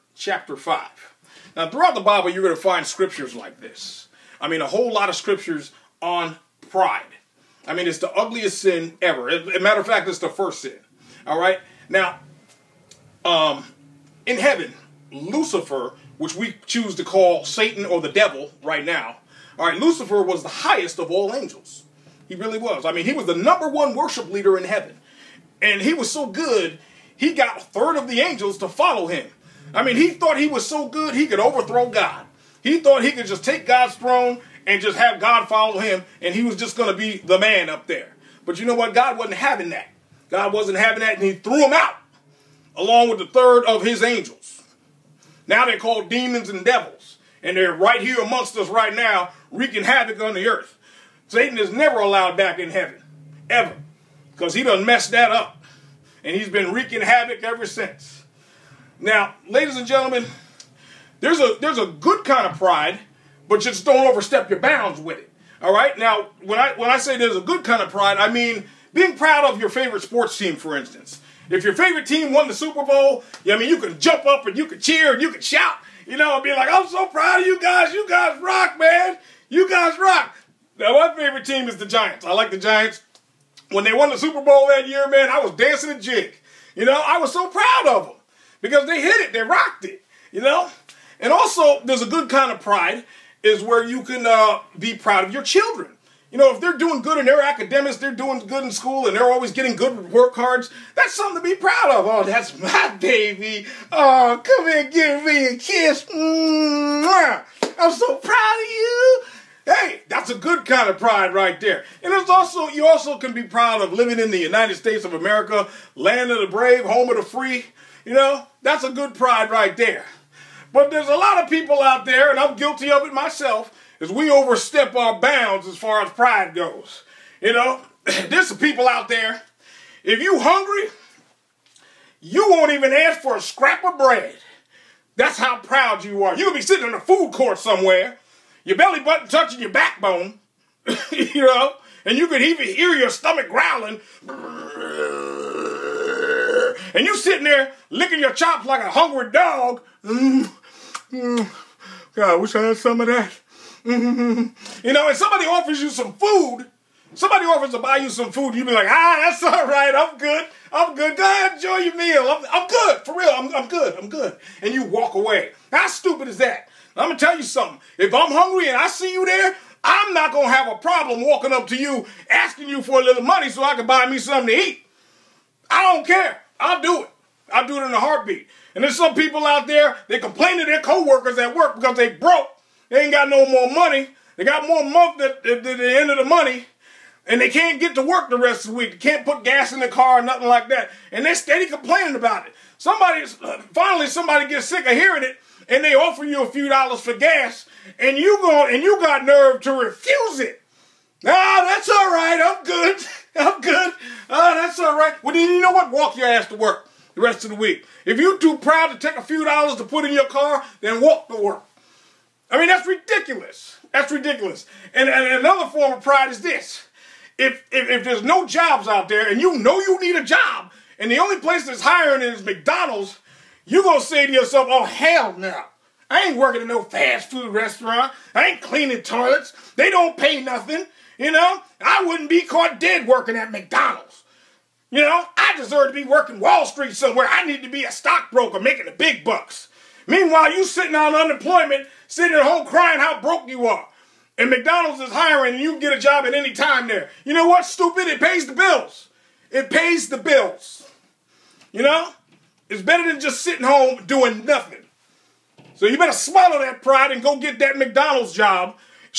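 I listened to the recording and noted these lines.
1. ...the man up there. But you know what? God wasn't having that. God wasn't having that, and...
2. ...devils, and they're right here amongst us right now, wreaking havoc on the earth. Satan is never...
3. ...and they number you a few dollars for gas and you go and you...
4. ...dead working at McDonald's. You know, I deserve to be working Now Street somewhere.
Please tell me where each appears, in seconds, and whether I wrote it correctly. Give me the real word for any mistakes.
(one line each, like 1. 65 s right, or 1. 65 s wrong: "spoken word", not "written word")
1. 37 s right
2. 46 s right
3. 195 s wrong: "offer", not "number"
4. 232 s wrong: "Wall", not "Now".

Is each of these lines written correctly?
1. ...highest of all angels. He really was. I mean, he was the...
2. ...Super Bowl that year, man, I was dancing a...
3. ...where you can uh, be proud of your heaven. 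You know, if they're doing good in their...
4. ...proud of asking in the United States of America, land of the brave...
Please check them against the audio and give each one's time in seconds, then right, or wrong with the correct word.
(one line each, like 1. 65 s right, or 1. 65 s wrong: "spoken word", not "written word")
1. 20 s right
2. 84 s right
3. 93 s wrong: "children", not "heaven"
4. 113 s wrong: "living", not "asking".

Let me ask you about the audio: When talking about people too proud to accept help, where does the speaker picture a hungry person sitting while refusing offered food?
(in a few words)
a food court.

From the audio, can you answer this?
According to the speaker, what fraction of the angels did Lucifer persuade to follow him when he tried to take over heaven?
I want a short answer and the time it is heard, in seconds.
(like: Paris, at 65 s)
a third, at 27 s.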